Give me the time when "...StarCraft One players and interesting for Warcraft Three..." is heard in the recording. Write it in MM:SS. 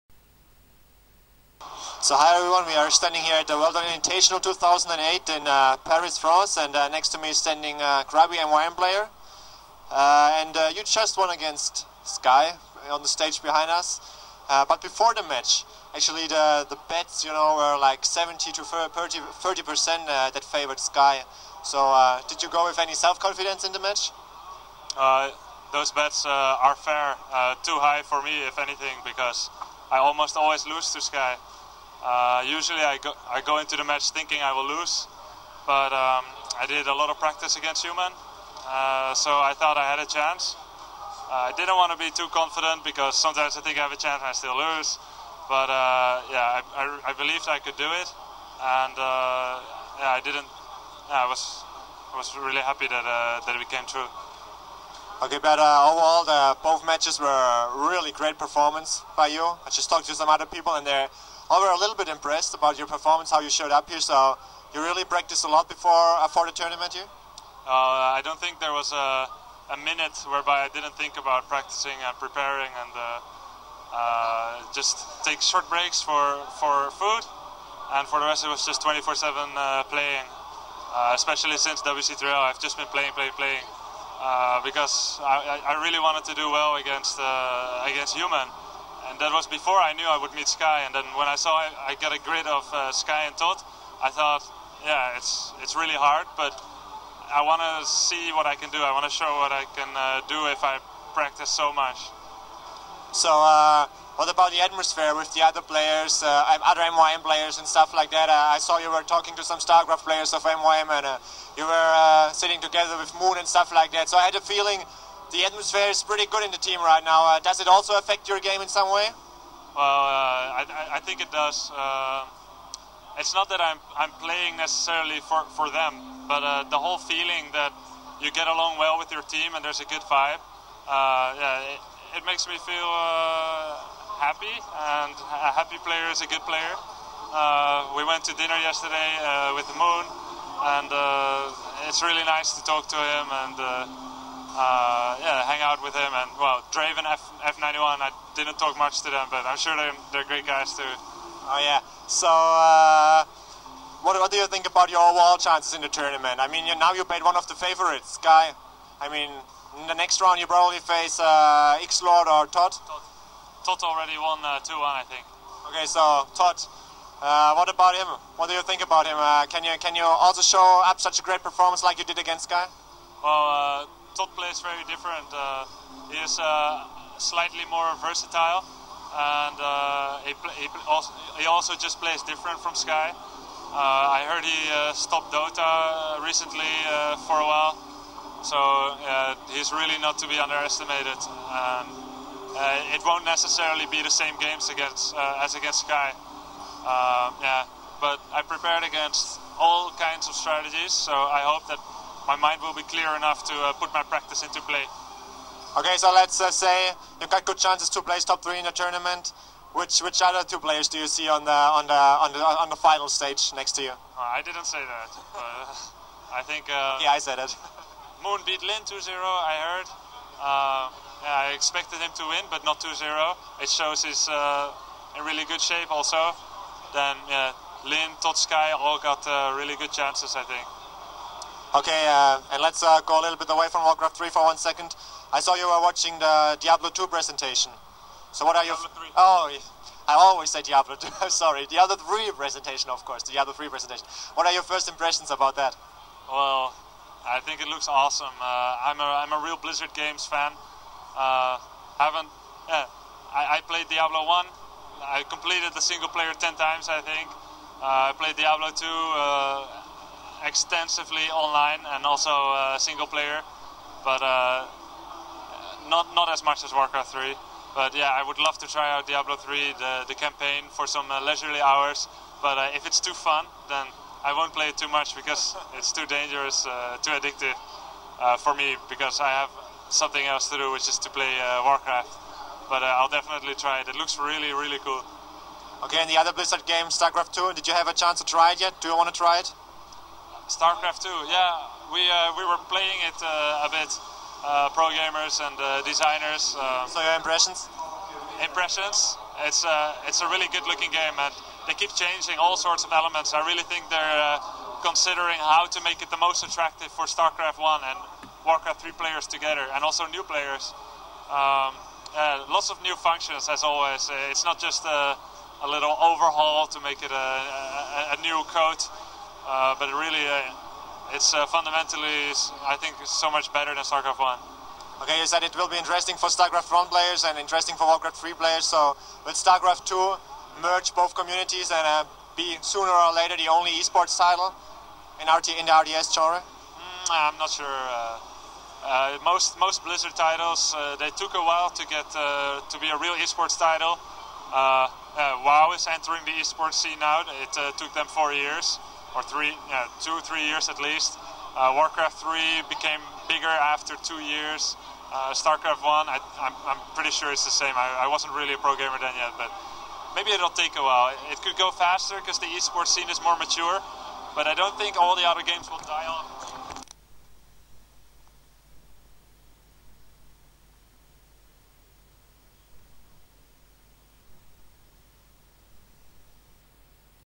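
05:26.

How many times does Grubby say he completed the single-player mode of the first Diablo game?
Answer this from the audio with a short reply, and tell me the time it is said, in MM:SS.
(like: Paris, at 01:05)
10, at 04:16.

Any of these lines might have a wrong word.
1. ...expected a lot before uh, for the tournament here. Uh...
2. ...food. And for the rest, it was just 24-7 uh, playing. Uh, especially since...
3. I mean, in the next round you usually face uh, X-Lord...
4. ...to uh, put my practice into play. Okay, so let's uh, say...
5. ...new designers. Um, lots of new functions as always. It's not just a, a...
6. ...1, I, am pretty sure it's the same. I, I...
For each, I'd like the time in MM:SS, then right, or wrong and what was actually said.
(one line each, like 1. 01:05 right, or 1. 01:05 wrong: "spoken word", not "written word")
1. 01:05 wrong: "practiced", not "expected"
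2. 01:16 right
3. 02:38 wrong: "probably", not "usually"
4. 03:23 right
5. 05:10 wrong: "players", not "designers"
6. 05:55 right.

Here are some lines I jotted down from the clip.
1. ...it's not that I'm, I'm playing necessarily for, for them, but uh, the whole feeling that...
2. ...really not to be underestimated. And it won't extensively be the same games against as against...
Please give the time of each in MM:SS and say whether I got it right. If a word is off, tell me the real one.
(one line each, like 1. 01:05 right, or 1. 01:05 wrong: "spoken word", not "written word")
1. 02:03 right
2. 03:09 wrong: "necessarily", not "extensively".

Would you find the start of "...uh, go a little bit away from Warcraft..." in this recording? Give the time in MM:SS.
03:52.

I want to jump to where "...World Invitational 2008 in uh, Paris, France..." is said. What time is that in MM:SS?
00:03.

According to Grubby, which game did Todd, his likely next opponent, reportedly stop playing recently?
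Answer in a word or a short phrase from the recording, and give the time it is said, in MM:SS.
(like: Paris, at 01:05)
Dota, at 03:05.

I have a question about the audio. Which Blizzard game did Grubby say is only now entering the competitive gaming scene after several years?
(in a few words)
WoW.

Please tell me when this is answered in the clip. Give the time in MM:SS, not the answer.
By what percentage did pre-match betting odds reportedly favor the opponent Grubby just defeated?
00:18.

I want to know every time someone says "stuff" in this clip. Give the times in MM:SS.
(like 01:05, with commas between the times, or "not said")
01:47, 01:53.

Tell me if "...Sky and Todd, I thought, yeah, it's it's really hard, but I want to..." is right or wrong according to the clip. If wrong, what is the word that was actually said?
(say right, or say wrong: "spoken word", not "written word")
right.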